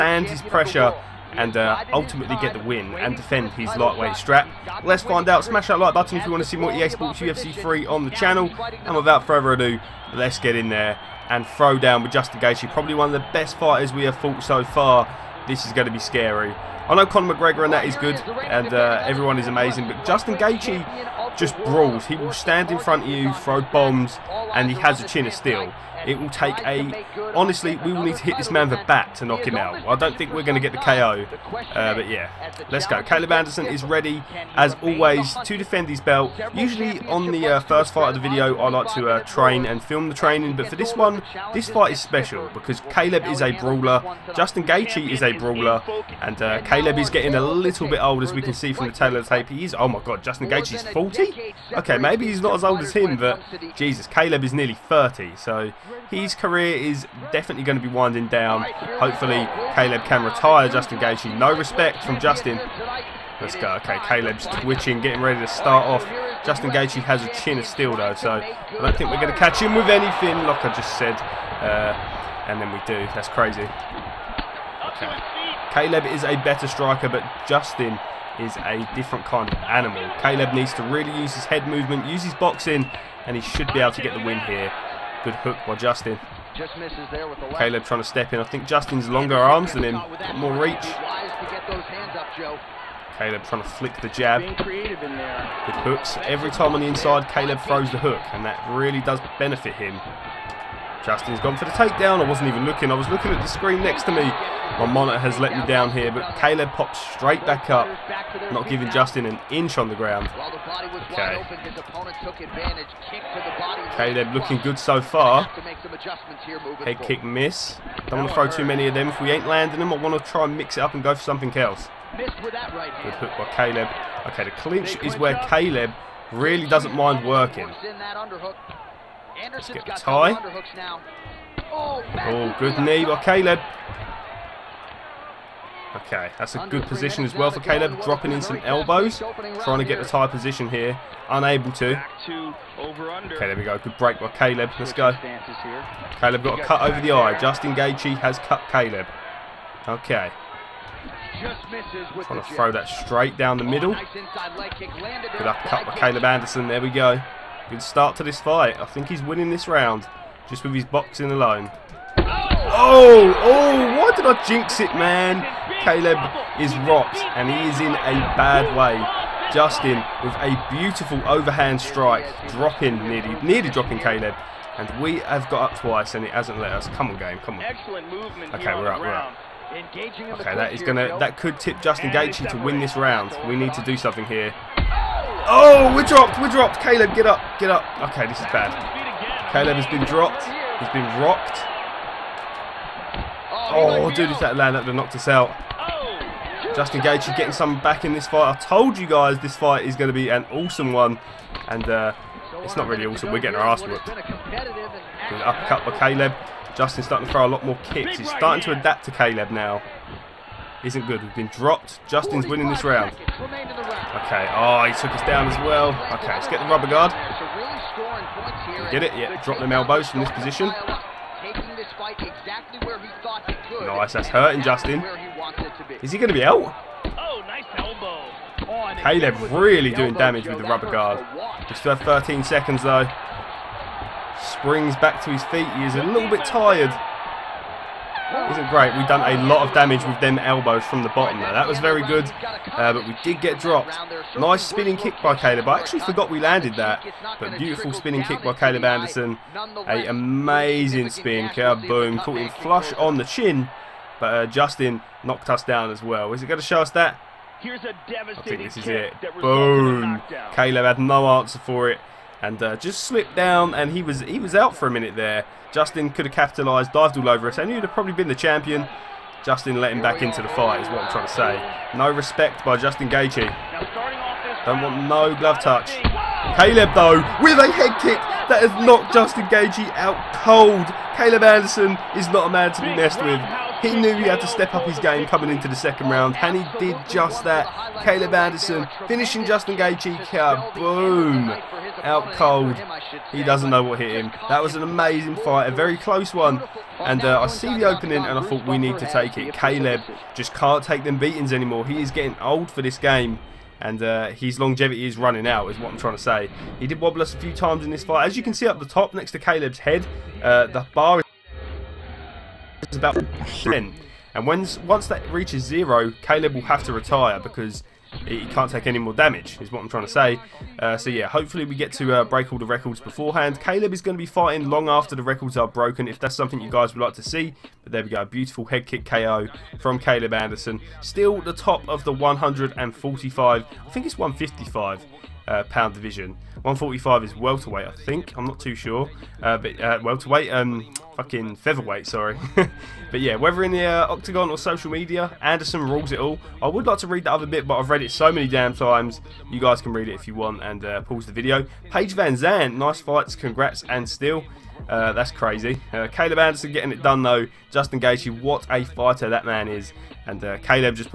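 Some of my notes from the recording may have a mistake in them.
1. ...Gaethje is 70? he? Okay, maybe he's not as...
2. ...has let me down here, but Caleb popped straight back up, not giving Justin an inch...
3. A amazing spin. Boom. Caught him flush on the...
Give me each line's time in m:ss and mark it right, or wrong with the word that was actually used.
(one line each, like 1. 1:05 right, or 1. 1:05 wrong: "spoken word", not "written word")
1. 0:50 wrong: "40", not "70"
2. 1:45 right
3. 4:09 right.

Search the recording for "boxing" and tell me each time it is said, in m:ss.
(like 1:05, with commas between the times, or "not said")
1:22, 2:40.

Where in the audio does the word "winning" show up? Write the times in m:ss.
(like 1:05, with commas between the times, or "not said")
2:39, 3:32.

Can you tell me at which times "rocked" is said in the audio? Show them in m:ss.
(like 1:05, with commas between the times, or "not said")
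2:46, 3:11.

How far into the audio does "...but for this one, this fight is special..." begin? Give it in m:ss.
0:40.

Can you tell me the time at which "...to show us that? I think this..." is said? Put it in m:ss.
4:16.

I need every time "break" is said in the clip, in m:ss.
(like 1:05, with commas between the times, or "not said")
2:23, 5:22.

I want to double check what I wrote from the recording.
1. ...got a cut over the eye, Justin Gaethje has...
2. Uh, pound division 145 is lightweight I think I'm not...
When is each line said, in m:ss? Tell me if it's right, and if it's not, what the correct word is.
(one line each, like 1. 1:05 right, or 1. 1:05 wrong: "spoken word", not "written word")
1. 2:26 right
2. 5:35 wrong: "welterweight", not "lightweight".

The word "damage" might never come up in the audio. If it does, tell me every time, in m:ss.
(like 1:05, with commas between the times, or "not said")
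3:50, 3:59, 5:19.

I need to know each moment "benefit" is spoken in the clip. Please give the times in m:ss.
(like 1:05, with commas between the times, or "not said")
1:39.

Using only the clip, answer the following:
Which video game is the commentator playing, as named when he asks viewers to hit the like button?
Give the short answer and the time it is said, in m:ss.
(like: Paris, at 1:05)
EA Sports UFC 3, at 0:06.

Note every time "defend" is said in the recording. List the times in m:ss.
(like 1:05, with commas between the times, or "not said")
0:03, 0:35.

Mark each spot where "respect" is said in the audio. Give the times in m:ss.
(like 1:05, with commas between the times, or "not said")
1:01, 4:32.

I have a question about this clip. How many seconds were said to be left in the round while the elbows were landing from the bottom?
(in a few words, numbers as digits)
13.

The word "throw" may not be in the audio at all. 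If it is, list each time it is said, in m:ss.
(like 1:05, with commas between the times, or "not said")
0:11, 0:23, 1:37, 1:58, 2:32, 3:27.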